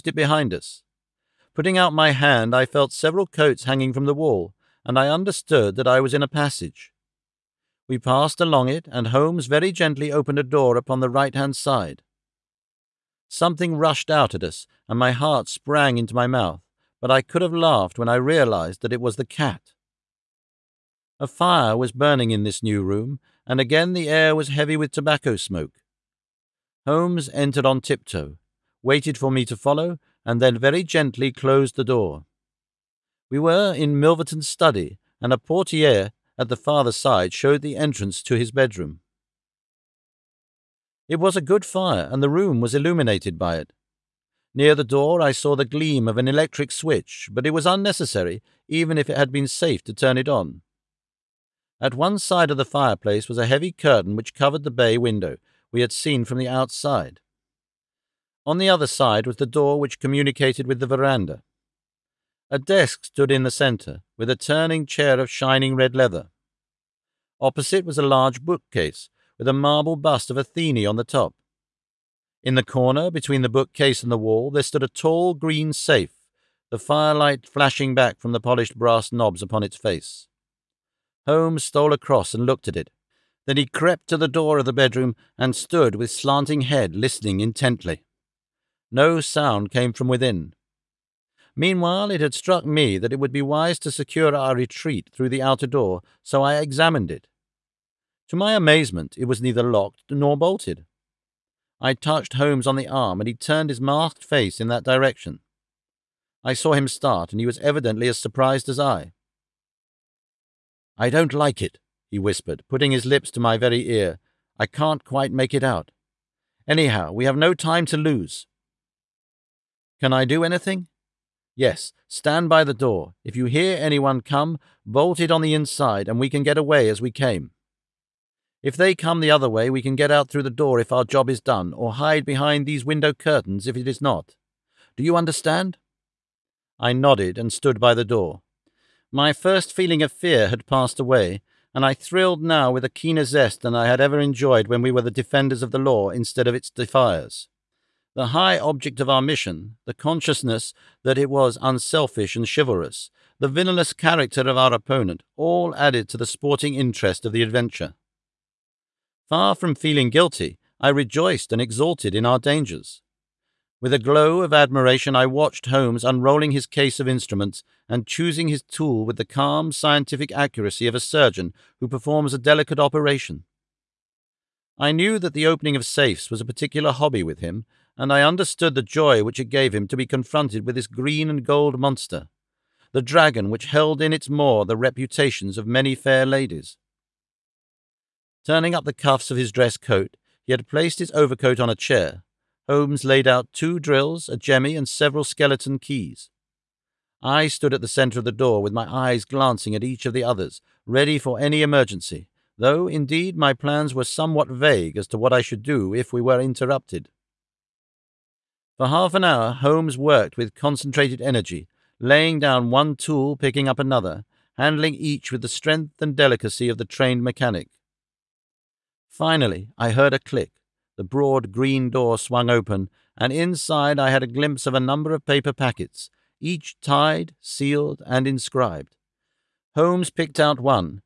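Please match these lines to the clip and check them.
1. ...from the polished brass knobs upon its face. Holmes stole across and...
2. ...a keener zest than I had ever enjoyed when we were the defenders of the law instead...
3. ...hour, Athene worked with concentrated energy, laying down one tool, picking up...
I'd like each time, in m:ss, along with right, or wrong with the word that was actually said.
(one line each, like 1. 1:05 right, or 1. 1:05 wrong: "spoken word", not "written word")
1. 1:18 right
2. 2:22 right
3. 3:29 wrong: "Holmes", not "Athene".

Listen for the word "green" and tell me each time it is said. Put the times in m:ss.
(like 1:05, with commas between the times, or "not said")
1:15, 3:00, 3:41.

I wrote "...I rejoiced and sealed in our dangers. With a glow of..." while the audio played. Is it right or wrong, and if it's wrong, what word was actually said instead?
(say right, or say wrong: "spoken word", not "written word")
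wrong: "exulted", not "sealed".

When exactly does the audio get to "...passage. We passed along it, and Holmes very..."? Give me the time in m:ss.
0:06.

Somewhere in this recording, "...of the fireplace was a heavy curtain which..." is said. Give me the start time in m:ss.
0:52.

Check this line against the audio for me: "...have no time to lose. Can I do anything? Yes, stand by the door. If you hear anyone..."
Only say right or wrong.
right.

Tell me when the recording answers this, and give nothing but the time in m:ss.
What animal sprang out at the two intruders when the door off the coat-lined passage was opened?
0:19.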